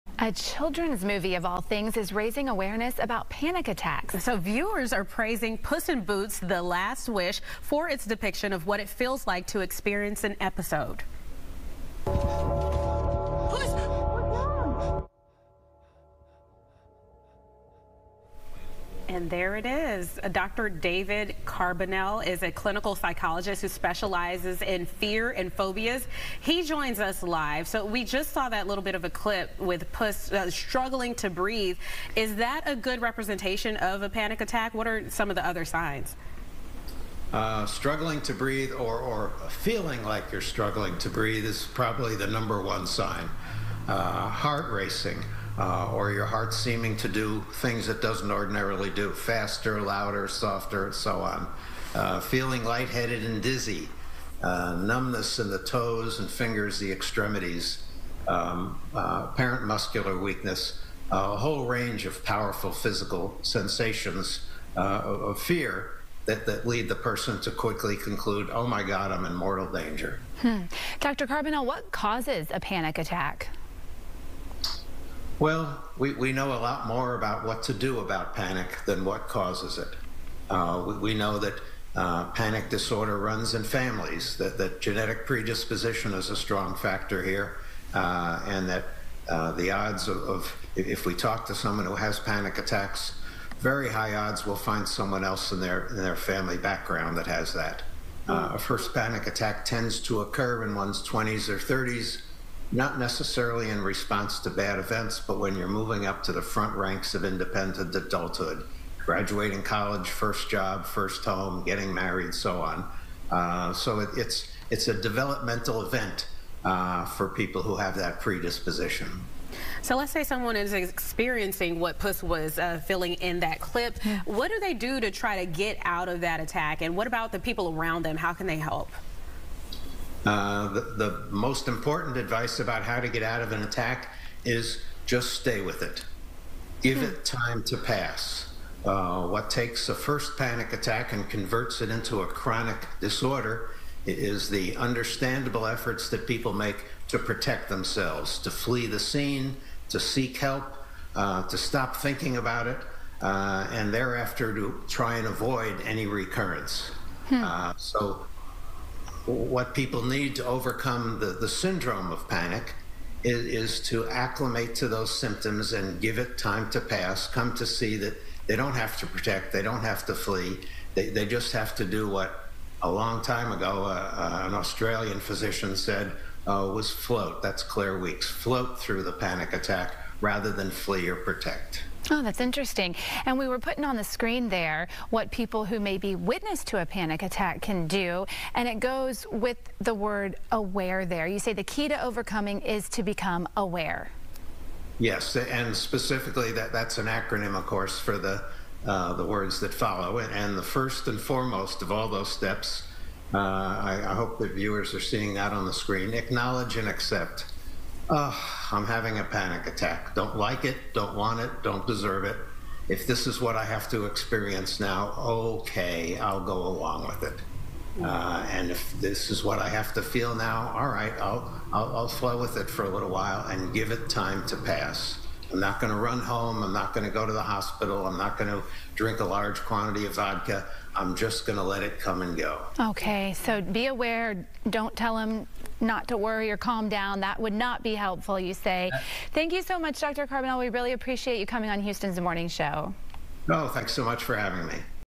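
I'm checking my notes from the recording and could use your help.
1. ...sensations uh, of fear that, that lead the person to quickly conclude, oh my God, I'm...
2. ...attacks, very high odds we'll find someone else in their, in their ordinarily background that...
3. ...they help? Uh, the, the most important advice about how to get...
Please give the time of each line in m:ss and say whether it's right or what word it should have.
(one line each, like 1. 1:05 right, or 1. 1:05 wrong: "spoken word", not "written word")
1. 1:03 right
2. 1:32 wrong: "family", not "ordinarily"
3. 2:08 right.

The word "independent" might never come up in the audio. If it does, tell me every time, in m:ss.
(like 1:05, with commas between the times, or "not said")
1:47.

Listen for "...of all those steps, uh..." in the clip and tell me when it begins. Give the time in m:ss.
3:21.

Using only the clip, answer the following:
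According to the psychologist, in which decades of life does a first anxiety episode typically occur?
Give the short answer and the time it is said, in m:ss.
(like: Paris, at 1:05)
20s or 30s, at 1:41.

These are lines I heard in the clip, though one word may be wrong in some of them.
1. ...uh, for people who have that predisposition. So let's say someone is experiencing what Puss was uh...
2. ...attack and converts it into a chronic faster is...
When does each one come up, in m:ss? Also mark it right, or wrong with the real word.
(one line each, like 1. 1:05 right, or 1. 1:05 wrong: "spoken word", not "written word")
1. 1:56 right
2. 2:20 wrong: "disorder", not "faster".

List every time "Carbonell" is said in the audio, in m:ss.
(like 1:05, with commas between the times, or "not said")
0:21, 1:11, 4:00.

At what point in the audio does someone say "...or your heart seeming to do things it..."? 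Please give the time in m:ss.
0:45.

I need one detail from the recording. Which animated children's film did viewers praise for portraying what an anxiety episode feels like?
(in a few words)
Puss in Boots The Last Wish.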